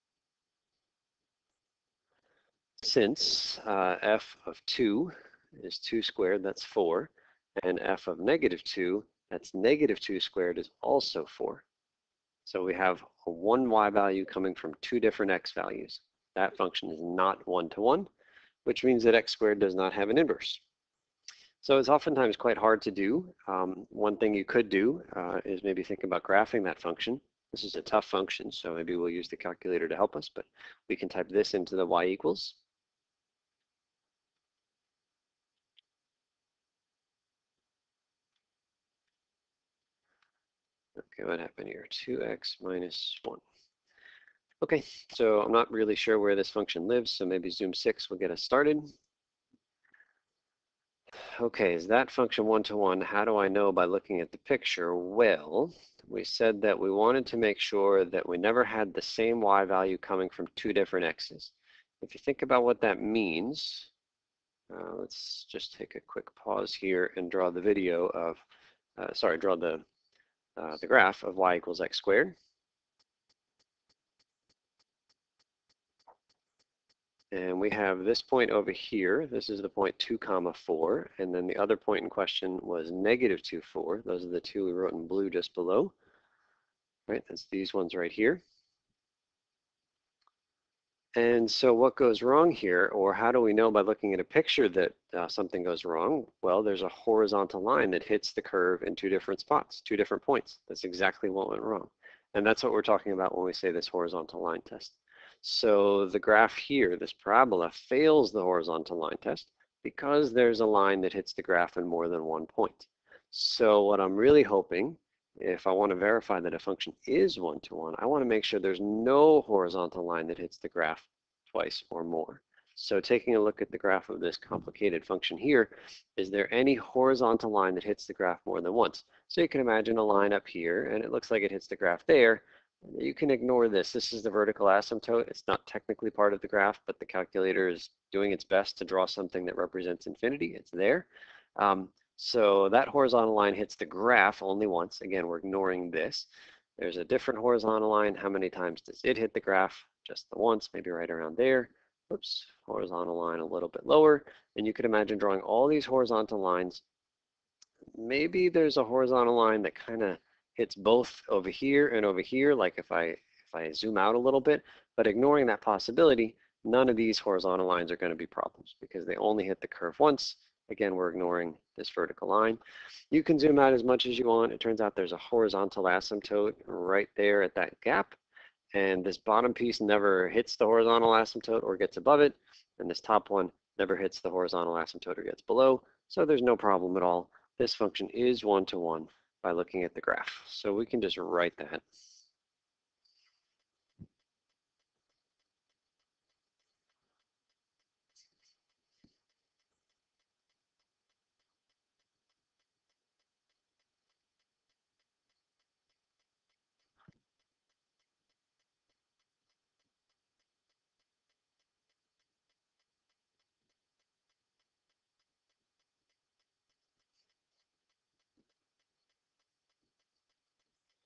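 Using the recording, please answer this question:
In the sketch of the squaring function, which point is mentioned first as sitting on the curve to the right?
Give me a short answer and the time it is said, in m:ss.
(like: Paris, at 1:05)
(2, 4), at 1:19.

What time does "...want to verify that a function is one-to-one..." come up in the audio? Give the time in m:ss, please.
1:55.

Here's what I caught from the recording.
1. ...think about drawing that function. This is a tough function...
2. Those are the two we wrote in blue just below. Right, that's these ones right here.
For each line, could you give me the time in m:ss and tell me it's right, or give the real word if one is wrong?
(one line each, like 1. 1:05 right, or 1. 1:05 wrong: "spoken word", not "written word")
1. 0:25 wrong: "graphing", not "drawing"
2. 1:24 right.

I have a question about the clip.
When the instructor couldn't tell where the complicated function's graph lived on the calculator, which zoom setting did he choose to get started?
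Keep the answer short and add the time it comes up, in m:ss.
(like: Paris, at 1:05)
zoom 6, at 0:47.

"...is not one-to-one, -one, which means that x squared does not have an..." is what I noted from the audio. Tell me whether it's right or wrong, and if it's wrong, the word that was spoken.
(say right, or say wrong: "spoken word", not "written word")
right.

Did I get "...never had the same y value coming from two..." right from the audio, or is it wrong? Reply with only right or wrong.
right.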